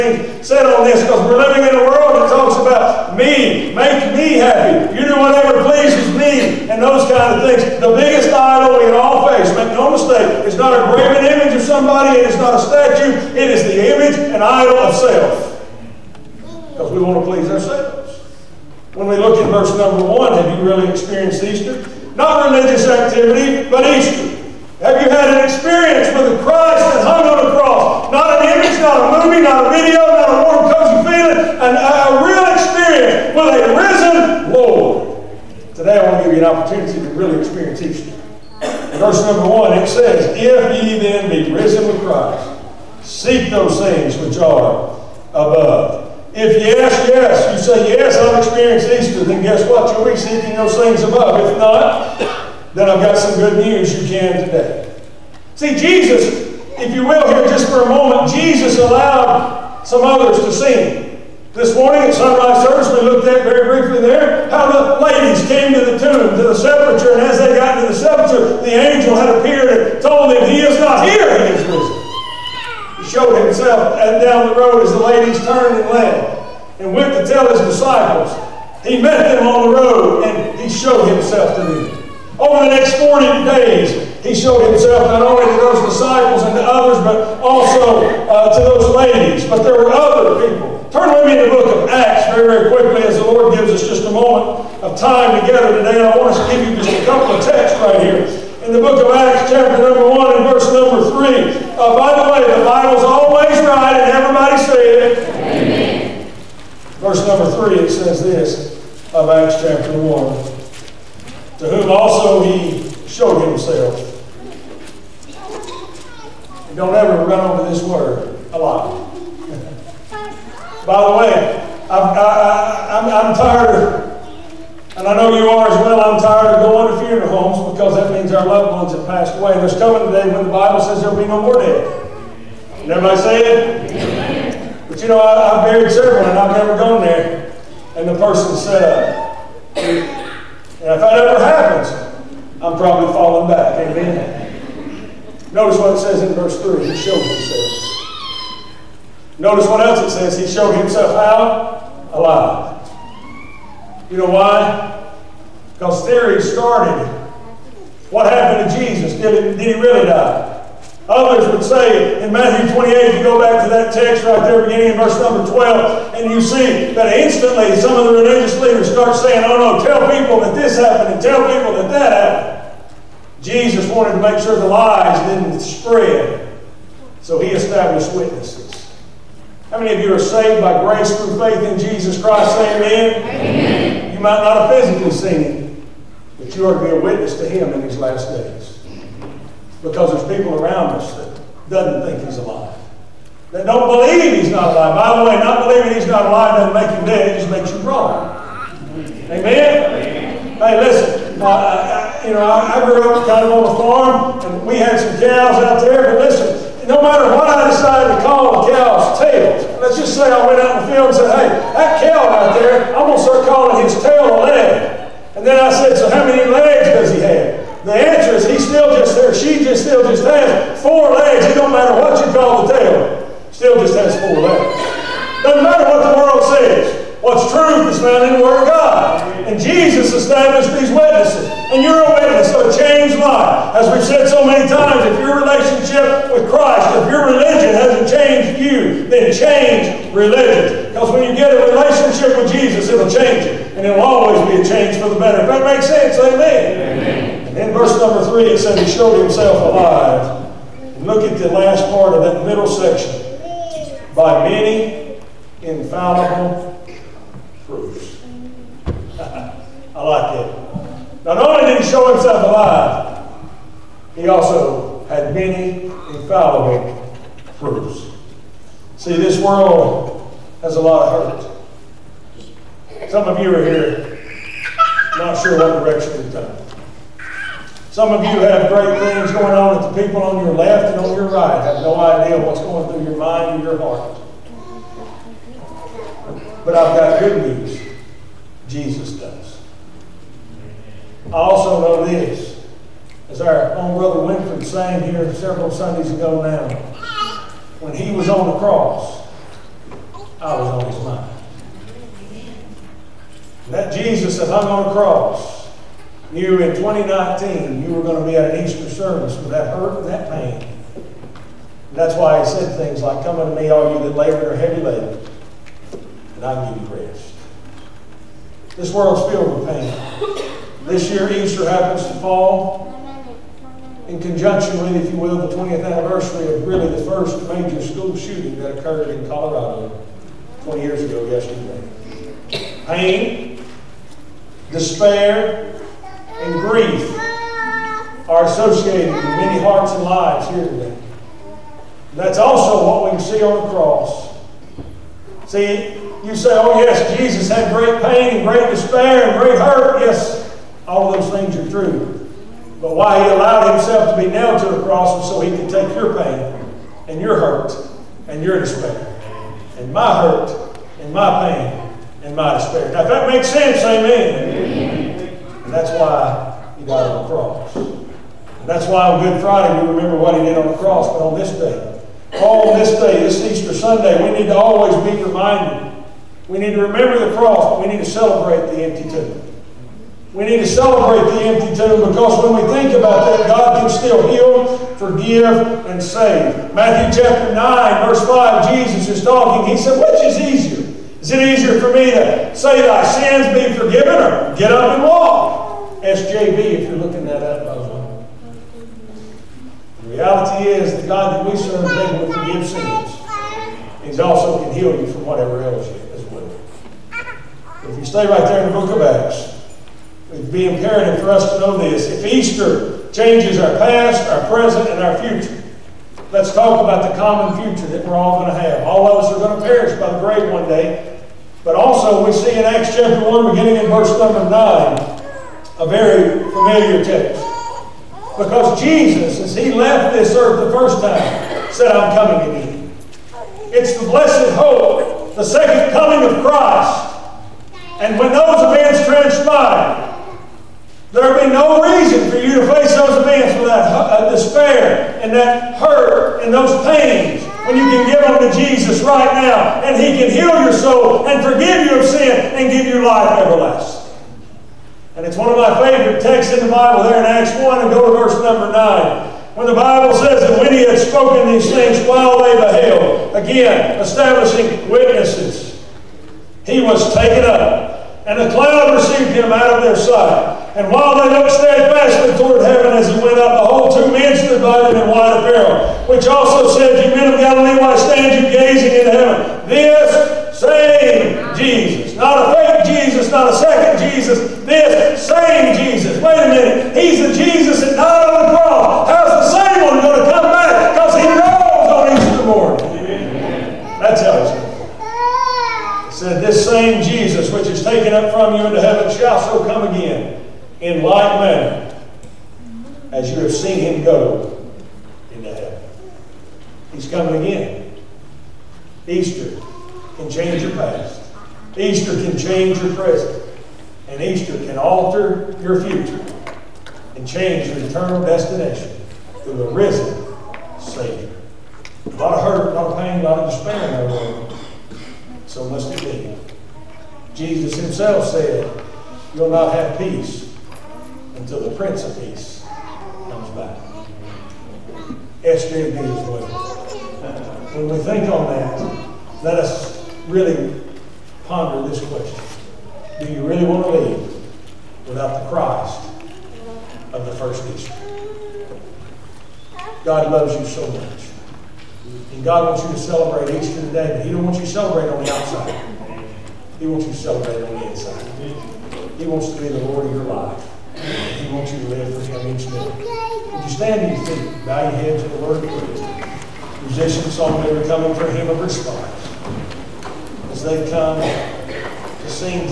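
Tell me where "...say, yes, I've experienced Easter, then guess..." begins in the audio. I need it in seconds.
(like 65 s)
47 s.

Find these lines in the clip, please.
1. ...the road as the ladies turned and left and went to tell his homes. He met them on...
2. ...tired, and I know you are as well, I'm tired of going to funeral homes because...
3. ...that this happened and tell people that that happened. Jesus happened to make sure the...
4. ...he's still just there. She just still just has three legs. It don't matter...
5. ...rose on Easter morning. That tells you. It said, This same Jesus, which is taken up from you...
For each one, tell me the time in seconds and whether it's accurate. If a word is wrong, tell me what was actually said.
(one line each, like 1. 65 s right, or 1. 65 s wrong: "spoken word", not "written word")
1. 74 s wrong: "disciples", not "homes"
2. 123 s right
3. 170 s wrong: "wanted", not "happened"
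4. 218 s wrong: "four", not "three"
5. 491 s right.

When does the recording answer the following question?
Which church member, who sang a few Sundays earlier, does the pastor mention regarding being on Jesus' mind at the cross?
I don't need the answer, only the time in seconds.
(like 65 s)
294 s.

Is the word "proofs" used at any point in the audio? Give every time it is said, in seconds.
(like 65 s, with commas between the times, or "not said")
257 s, 267 s.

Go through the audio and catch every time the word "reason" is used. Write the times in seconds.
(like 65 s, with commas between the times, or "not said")
441 s.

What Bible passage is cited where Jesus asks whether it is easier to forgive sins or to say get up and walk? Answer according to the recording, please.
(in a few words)
Matthew 9:5.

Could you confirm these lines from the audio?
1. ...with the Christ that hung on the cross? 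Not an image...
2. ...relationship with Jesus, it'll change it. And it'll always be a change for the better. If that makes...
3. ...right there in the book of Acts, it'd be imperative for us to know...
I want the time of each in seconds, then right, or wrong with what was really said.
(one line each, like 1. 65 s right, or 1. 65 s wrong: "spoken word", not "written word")
1. 26 s right
2. 241 s right
3. 408 s right.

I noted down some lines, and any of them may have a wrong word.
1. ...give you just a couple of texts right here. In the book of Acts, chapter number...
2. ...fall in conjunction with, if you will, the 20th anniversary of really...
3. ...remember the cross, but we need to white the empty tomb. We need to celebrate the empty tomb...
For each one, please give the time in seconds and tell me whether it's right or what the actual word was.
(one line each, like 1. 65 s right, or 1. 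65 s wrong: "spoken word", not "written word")
1. 96 s right
2. 322 s right
3. 376 s wrong: "celebrate", not "white".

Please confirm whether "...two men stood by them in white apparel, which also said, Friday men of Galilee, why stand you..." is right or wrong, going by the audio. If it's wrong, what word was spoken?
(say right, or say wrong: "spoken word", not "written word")
wrong: "You", not "Friday".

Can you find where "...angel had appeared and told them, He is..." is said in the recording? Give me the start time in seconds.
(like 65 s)
68 s.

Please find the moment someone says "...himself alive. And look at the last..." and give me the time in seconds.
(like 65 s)
249 s.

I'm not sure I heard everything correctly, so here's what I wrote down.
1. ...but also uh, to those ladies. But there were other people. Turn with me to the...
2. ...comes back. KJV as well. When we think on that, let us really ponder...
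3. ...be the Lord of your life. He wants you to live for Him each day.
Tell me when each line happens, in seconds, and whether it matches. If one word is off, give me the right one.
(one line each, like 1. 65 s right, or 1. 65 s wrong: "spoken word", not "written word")
1. 87 s right
2. 533 s right
3. 559 s right.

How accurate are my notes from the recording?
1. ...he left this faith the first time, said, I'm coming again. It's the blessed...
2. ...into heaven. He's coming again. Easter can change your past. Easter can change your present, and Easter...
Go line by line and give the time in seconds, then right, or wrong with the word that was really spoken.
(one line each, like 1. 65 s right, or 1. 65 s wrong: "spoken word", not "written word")
1. 429 s wrong: "earth", not "faith"
2. 505 s right.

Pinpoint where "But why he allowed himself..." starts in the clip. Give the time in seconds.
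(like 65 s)
352 s.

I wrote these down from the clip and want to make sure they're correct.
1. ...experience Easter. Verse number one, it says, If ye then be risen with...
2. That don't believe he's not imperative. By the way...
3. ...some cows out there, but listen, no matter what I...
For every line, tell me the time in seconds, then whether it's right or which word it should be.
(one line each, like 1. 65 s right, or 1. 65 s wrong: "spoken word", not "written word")
1. 37 s right
2. 193 s wrong: "alive", not "imperative"
3. 204 s right.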